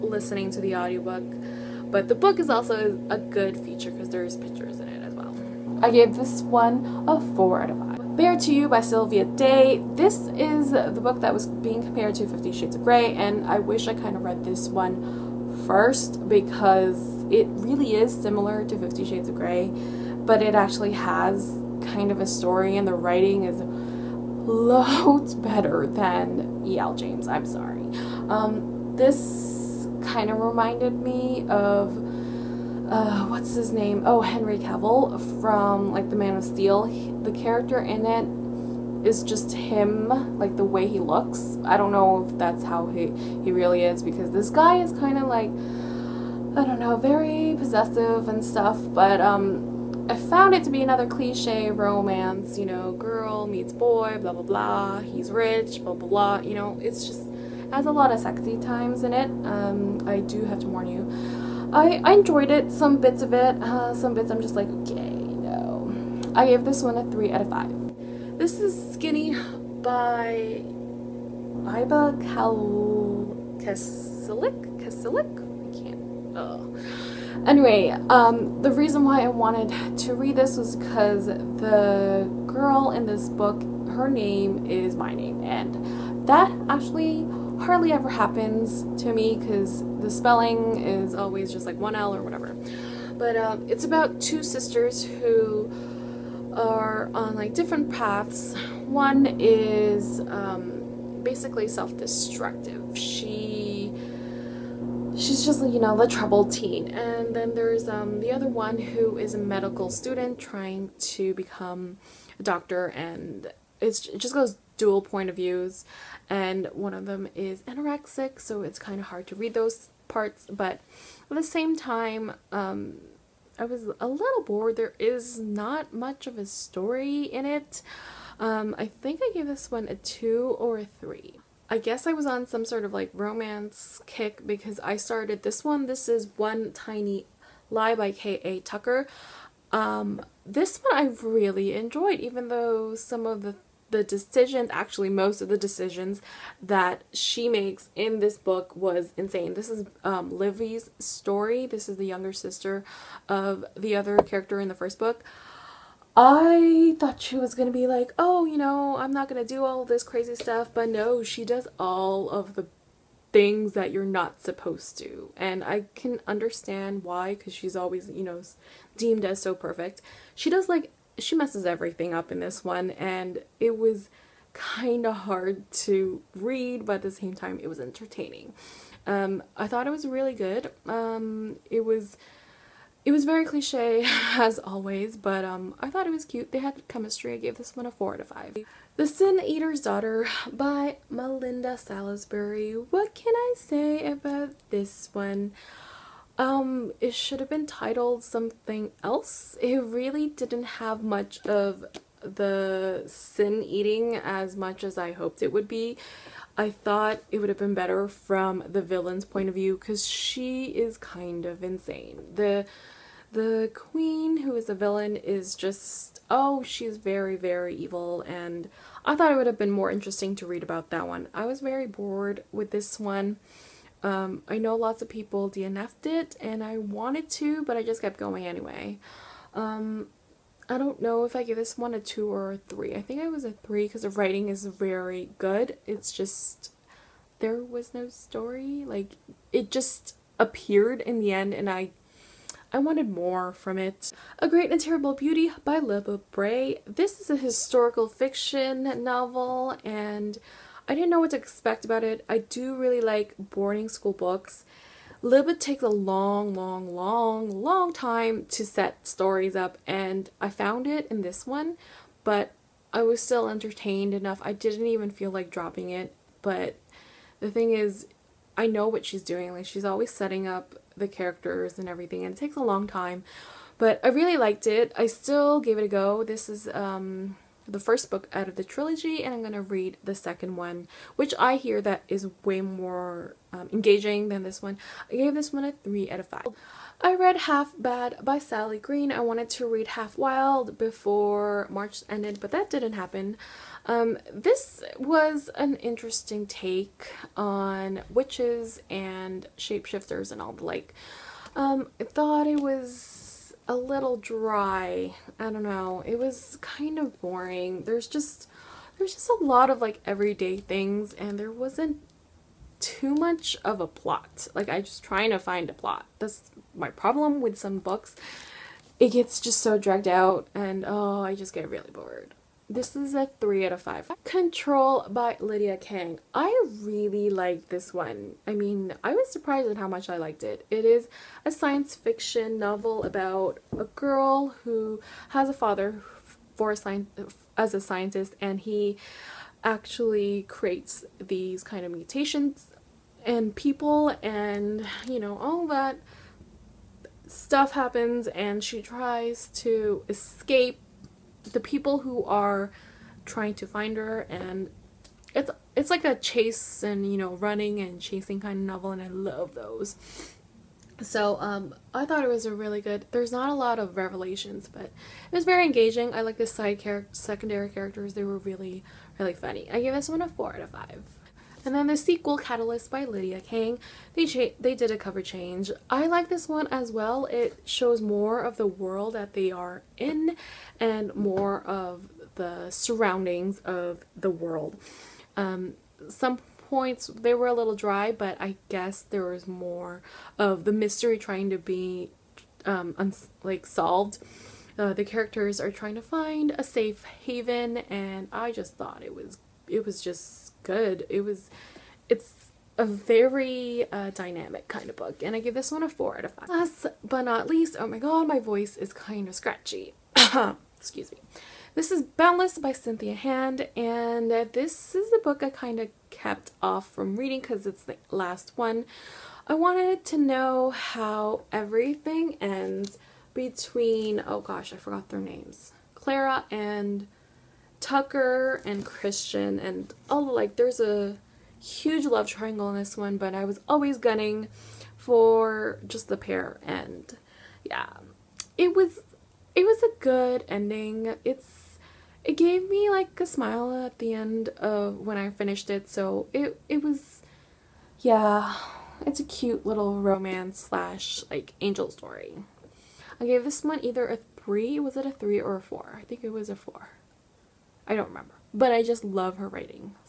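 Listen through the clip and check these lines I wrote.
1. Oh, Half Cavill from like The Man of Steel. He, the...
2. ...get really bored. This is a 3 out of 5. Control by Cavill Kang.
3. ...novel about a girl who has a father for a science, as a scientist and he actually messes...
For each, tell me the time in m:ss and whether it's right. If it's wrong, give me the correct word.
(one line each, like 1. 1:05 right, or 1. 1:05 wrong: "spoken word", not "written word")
1. 0:34 wrong: "Henry", not "Half"
2. 5:21 wrong: "Lydia", not "Cavill"
3. 5:32 wrong: "creates", not "messes".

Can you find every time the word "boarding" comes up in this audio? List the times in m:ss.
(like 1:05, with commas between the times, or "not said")
4:13.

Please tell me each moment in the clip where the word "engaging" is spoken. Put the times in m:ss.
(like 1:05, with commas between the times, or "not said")
4:43, 6:05.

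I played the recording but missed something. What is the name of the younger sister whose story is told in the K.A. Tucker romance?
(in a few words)
Livy.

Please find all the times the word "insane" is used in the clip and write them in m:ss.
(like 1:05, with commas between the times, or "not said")
2:29, 3:31.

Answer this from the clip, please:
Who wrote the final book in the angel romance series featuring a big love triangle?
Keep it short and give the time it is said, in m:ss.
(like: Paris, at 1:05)
Cynthia Hand, at 6:52.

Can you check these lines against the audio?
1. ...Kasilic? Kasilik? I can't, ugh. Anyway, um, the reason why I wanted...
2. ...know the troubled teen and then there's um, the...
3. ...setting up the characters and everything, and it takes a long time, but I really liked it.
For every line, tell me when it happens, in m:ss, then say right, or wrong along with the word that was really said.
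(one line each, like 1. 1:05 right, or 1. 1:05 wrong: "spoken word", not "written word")
1. 1:13 right
2. 1:45 right
3. 4:30 right.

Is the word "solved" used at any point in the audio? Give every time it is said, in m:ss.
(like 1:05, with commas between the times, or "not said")
6:33.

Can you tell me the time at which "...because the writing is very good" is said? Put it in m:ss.
3:53.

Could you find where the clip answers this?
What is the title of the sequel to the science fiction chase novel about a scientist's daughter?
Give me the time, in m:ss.
6:12.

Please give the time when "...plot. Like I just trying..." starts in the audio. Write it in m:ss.
5:13.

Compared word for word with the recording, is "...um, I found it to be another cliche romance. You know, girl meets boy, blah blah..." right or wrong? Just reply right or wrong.
right.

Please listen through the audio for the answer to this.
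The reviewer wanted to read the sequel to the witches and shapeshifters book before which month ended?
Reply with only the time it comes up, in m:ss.
4:51.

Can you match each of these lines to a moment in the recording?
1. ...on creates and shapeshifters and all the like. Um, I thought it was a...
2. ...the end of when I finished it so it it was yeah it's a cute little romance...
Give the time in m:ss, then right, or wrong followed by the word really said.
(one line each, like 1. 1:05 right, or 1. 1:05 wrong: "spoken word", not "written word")
1. 4:57 wrong: "witches", not "creates"
2. 7:24 right.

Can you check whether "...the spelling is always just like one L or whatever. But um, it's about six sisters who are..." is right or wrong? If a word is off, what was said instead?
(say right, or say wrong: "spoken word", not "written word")
wrong: "two", not "six".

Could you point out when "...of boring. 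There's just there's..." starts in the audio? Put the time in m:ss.
5:06.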